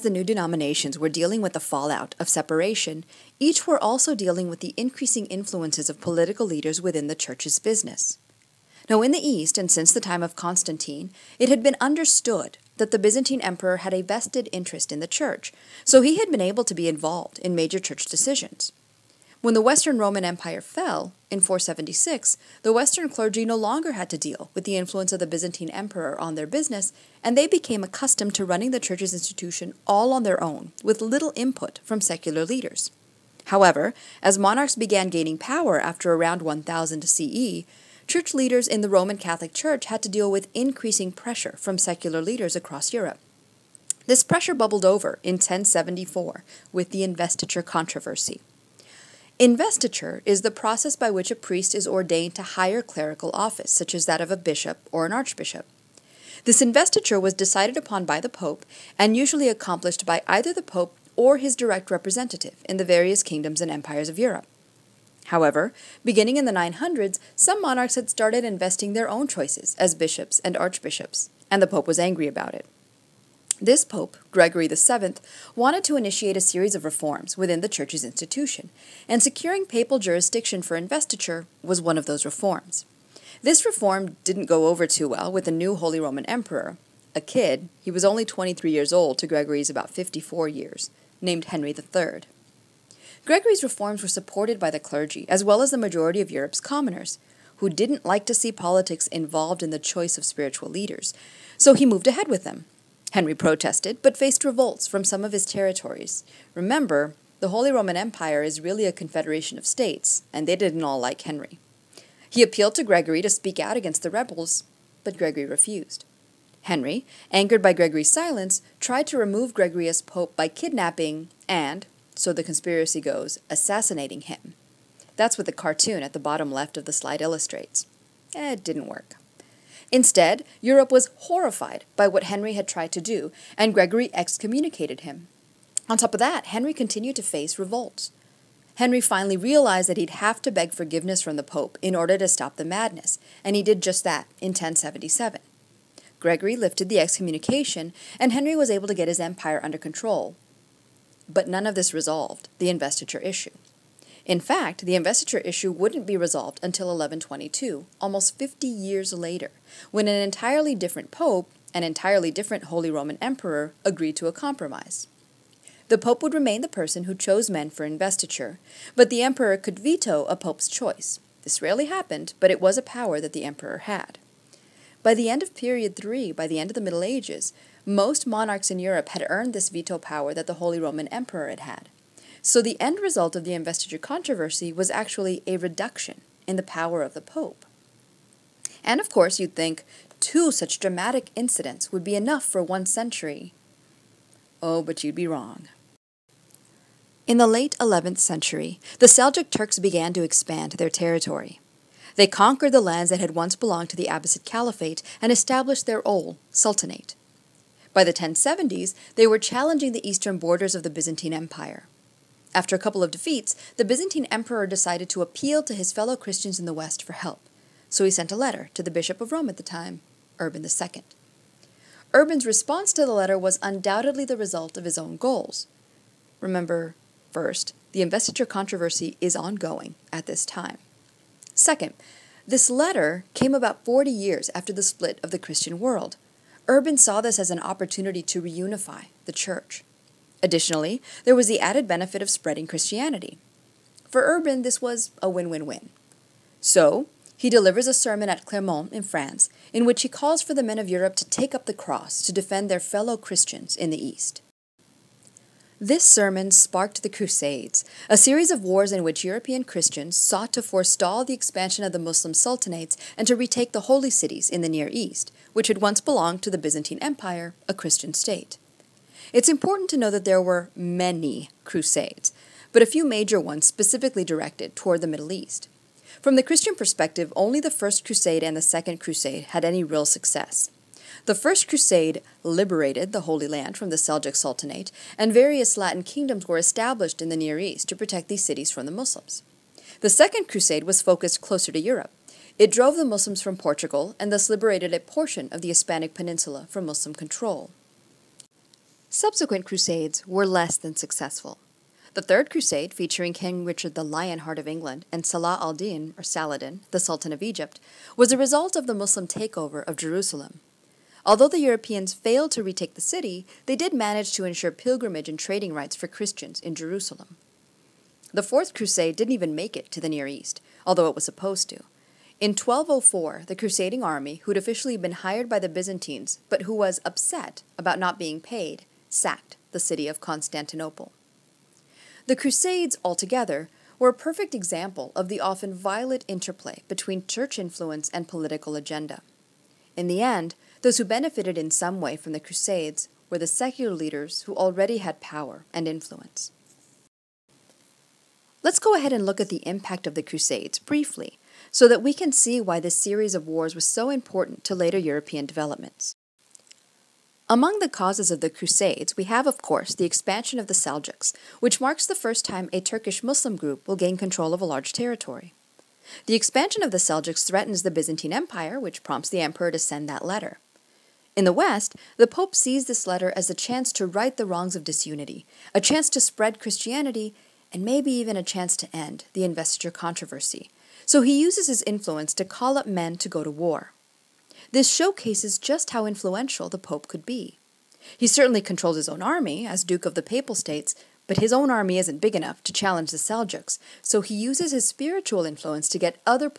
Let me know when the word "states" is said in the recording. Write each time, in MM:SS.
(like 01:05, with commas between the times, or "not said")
01:49, 04:28, 06:30.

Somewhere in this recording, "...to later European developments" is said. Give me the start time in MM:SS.
05:54.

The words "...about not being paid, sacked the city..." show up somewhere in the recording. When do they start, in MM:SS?
05:27.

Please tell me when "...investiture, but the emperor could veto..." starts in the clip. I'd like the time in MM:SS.
02:47.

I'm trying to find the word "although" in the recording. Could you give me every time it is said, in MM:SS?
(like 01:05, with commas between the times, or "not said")
05:11, 05:20.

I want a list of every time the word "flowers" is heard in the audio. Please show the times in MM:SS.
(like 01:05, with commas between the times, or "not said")
not said.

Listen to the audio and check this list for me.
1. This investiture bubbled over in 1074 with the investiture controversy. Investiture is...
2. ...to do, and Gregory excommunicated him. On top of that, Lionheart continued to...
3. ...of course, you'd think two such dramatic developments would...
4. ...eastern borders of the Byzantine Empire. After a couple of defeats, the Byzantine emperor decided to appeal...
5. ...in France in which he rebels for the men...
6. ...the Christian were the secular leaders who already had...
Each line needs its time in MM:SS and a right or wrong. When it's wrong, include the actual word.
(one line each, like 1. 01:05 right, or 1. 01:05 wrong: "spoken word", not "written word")
1. 00:44 wrong: "pressure", not "investiture"
2. 02:12 wrong: "Henry", not "Lionheart"
3. 03:08 wrong: "incidents", not "developments"
4. 03:30 right
5. 04:08 wrong: "calls", not "rebels"
6. 05:42 wrong: "Crusades", not "Christian".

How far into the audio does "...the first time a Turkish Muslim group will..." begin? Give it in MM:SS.
06:02.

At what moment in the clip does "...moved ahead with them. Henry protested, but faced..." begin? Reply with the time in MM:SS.
01:41.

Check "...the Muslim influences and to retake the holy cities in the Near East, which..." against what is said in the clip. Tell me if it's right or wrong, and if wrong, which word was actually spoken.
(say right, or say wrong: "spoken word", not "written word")
wrong: "sultanates", not "influences".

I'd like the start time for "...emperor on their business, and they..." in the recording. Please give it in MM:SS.
00:25.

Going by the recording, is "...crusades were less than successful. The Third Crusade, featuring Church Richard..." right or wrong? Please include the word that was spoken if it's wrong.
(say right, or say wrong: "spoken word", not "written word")
wrong: "King", not "Church".